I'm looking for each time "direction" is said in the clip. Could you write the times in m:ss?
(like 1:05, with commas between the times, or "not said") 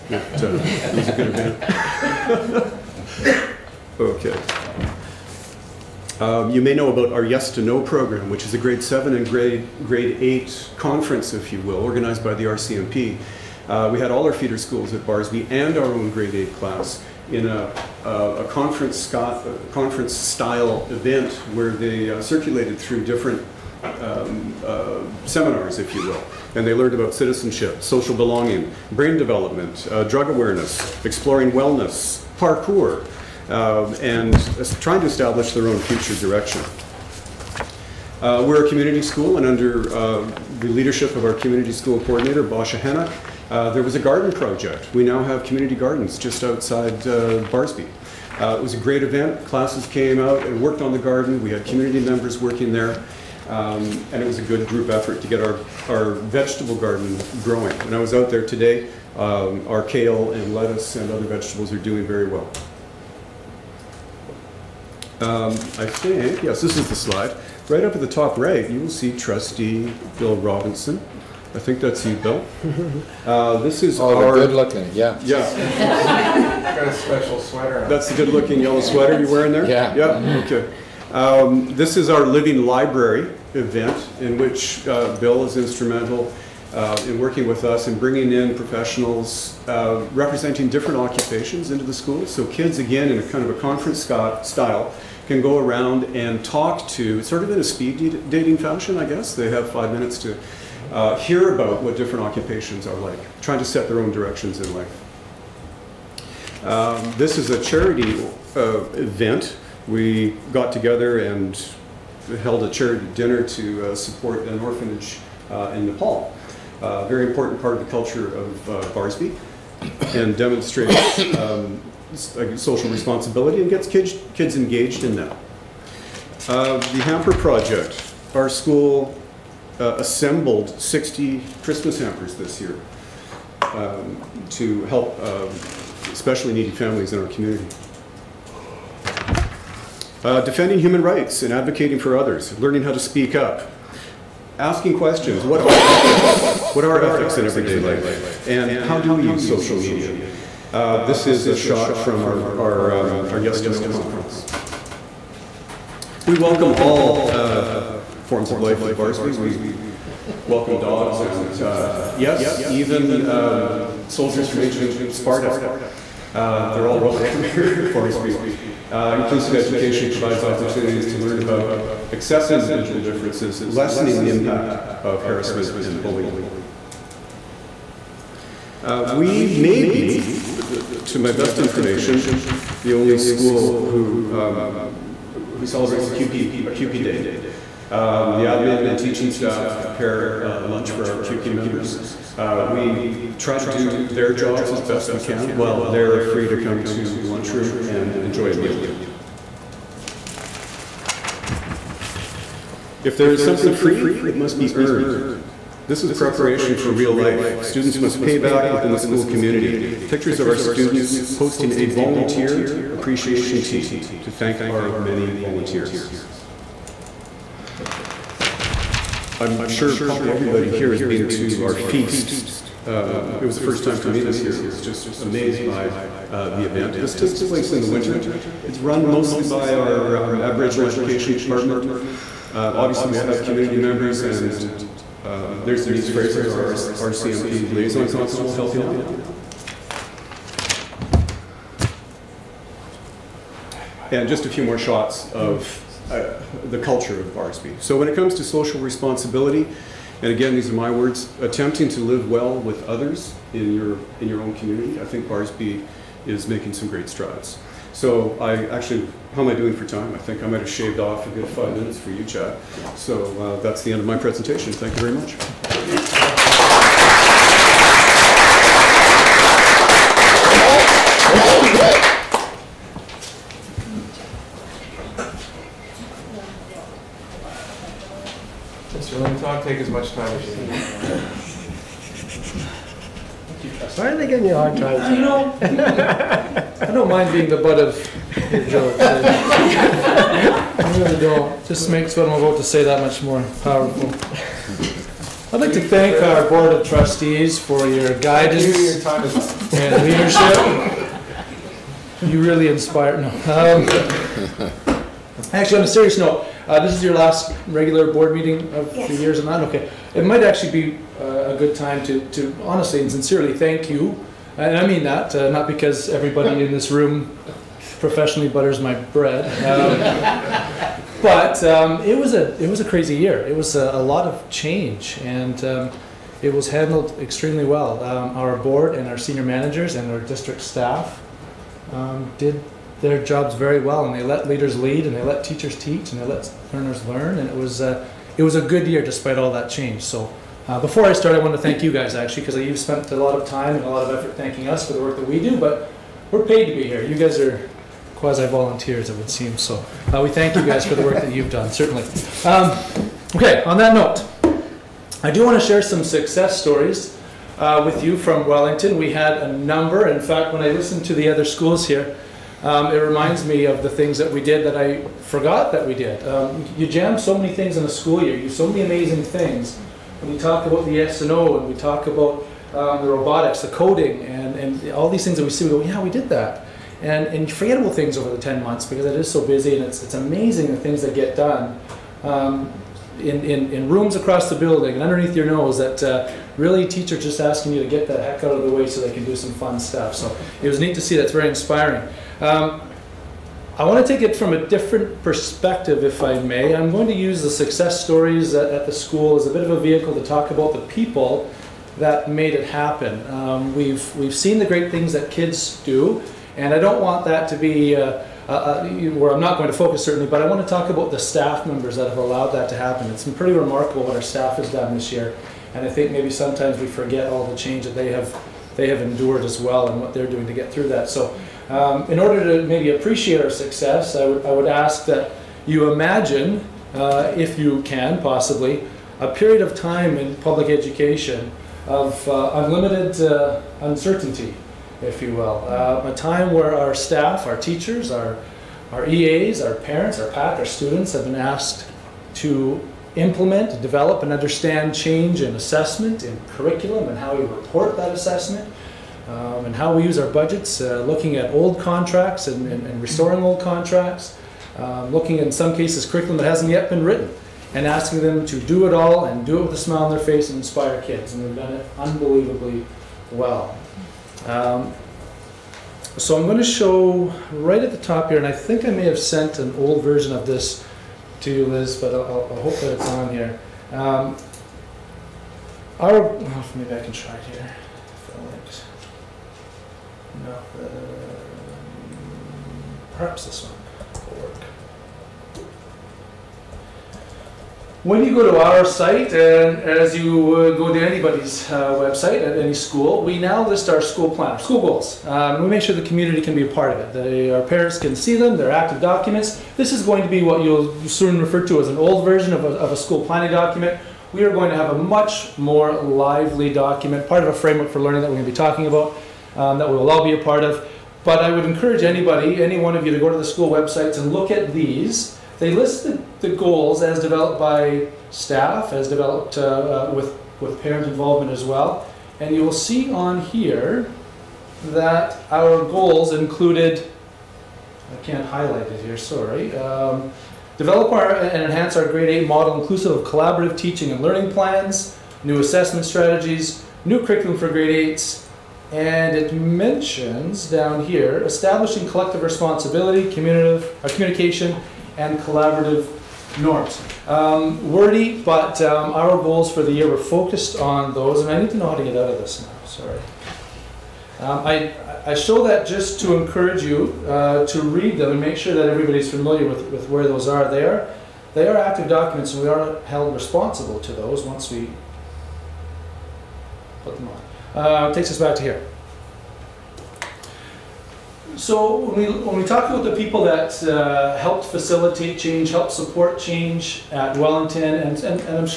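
0:36, 1:44.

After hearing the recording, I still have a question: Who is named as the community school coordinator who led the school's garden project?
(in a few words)
Basha Hanna.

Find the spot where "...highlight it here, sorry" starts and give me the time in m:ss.
8:48.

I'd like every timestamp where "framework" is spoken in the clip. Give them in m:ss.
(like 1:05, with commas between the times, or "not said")
8:27.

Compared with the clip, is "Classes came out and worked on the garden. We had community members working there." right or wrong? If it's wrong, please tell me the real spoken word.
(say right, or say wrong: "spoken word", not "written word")
right.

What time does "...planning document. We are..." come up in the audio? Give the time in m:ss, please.
8:23.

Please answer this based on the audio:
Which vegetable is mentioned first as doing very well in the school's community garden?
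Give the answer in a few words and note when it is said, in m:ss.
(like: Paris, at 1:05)
kale, at 0:59.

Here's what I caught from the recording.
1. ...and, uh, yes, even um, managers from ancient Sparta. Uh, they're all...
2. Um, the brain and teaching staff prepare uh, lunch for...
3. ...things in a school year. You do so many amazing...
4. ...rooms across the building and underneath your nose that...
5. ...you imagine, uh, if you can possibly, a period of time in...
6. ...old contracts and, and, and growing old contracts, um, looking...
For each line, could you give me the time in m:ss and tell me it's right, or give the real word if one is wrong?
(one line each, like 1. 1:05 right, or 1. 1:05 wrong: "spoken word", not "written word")
1. 2:41 wrong: "soldiers", not "managers"
2. 3:07 wrong: "admin", not "brain"
3. 6:07 right
4. 6:23 right
5. 7:05 right
6. 7:31 wrong: "restoring", not "growing".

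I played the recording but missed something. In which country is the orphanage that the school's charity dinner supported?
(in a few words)
Nepal.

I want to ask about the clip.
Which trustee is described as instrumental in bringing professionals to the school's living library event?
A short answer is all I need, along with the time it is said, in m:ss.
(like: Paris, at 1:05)
Bill Robinson, at 1:10.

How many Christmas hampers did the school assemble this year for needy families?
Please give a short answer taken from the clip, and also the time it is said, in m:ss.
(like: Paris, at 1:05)
60, at 2:10.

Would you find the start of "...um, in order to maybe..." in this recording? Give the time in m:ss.
7:01.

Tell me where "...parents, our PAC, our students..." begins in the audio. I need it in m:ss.
7:19.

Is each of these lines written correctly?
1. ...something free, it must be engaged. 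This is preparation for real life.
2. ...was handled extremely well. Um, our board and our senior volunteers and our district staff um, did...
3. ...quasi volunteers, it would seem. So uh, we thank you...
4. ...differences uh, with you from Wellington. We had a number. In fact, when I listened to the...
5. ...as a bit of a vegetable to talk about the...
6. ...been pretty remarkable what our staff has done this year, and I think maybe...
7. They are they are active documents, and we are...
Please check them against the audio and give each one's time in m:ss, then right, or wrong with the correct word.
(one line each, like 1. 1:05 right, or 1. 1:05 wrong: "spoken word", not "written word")
1. 3:23 wrong: "earned", not "engaged"
2. 5:26 wrong: "managers", not "volunteers"
3. 5:48 right
4. 5:56 wrong: "stories", not "differences"
5. 6:39 wrong: "vehicle", not "vegetable"
6. 6:53 right
7. 9:20 right.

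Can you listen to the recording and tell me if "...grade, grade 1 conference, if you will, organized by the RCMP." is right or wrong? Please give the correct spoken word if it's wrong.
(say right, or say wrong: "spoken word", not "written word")
wrong: "8", not "1".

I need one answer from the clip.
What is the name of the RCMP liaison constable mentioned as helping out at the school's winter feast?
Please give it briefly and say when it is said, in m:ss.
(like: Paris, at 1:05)
Denise Fraser, at 3:55.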